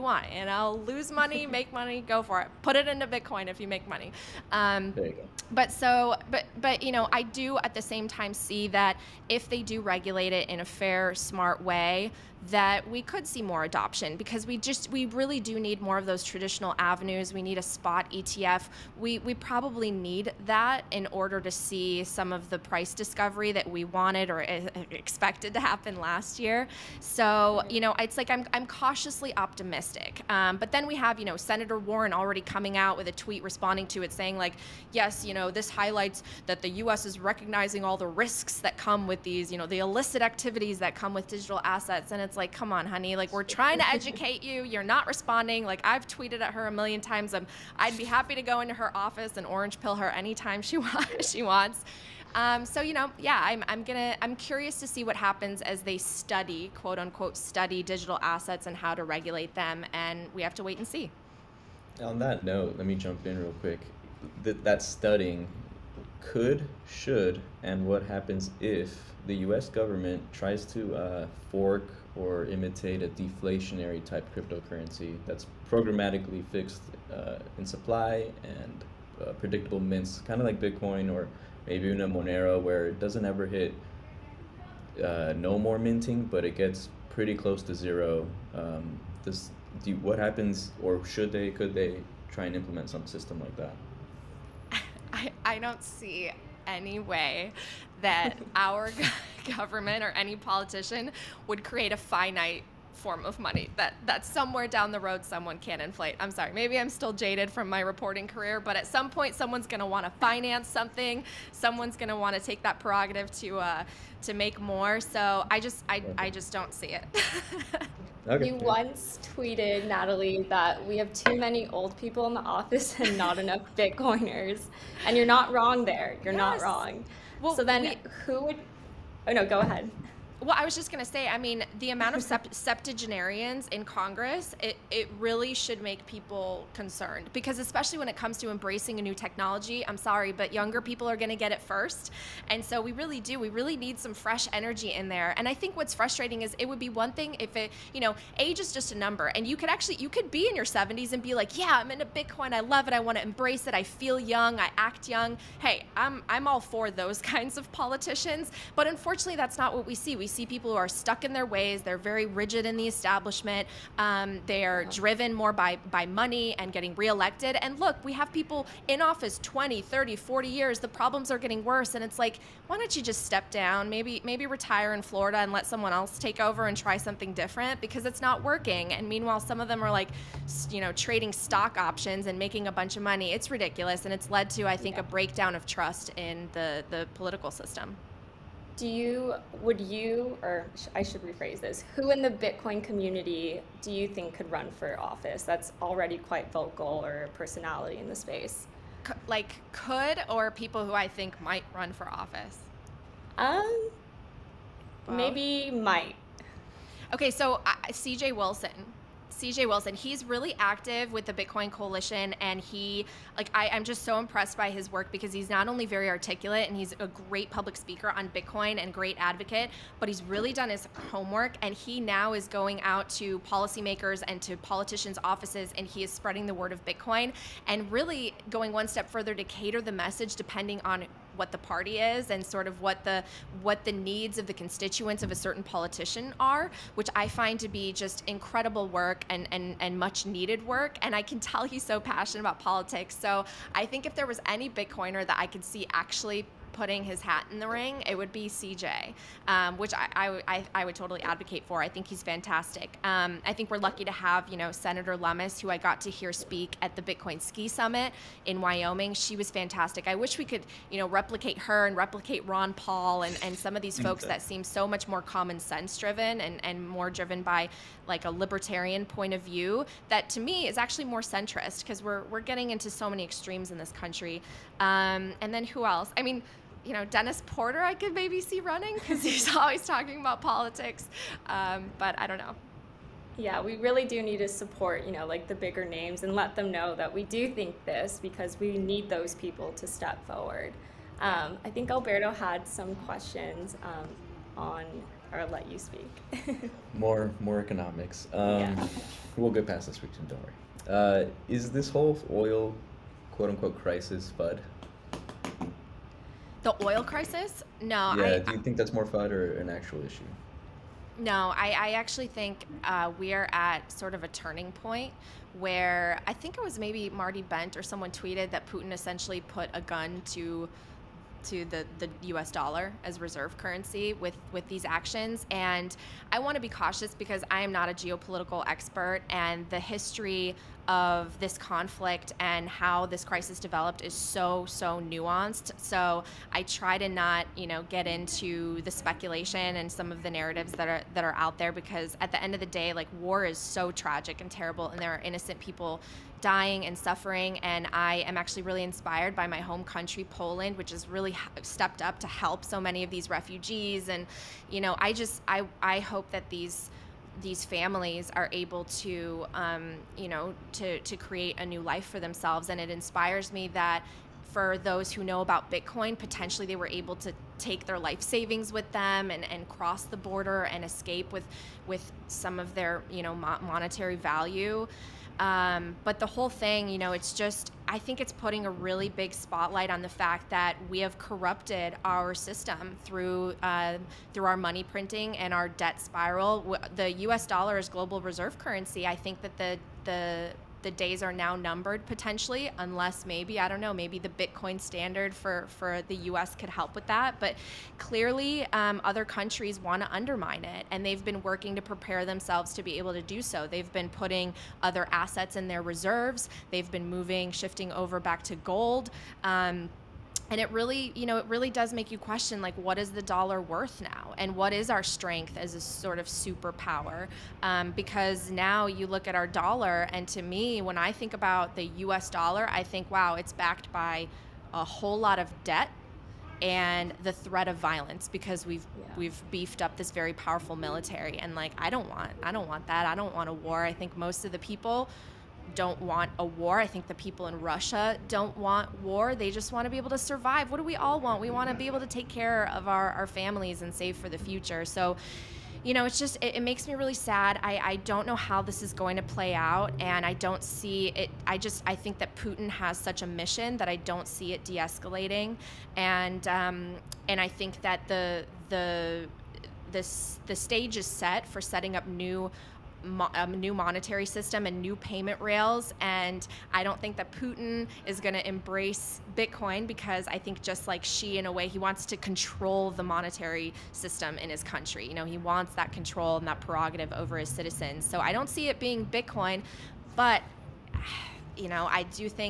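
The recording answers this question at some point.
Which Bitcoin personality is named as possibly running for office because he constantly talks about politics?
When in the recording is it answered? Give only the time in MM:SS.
04:37.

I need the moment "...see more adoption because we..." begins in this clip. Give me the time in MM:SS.
00:13.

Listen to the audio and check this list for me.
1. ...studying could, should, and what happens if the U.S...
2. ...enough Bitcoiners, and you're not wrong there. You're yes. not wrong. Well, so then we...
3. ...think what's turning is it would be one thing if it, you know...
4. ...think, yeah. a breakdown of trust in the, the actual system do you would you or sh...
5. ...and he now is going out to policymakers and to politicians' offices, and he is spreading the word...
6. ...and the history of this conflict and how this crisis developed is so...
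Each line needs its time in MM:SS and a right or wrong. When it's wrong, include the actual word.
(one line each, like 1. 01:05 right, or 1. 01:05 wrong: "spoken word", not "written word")
1. 01:04 right
2. 02:03 right
3. 02:25 wrong: "frustrating", not "turning"
4. 03:04 wrong: "political", not "actual"
5. 03:41 right
6. 05:29 right.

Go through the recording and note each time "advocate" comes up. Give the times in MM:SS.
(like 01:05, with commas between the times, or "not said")
03:39, 04:11.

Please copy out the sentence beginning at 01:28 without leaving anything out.
Um, this, do, what happens, or should they, could they try and implement some system like that?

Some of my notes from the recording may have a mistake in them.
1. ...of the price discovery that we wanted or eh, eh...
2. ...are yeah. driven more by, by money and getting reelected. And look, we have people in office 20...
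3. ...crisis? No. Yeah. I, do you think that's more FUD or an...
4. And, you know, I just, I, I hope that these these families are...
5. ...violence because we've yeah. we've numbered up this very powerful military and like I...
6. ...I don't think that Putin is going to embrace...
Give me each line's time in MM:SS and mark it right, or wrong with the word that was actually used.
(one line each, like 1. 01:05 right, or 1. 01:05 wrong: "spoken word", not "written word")
1. 00:22 right
2. 02:44 right
3. 05:07 right
4. 05:54 right
5. 07:07 wrong: "beefed", not "numbered"
6. 07:46 right.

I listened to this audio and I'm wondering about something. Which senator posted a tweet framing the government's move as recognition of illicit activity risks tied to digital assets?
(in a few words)
Senator Warren.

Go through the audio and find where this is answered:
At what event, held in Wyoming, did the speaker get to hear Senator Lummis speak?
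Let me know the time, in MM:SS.
04:17.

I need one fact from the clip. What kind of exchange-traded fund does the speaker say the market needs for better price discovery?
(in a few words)
spot ETF.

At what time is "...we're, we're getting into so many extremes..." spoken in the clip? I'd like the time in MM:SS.
04:32.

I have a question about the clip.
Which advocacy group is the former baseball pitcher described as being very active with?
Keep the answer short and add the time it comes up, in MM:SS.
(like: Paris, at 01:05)
Bitcoin Coalition, at 03:31.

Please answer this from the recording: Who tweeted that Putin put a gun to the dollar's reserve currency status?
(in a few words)
Marty Bent.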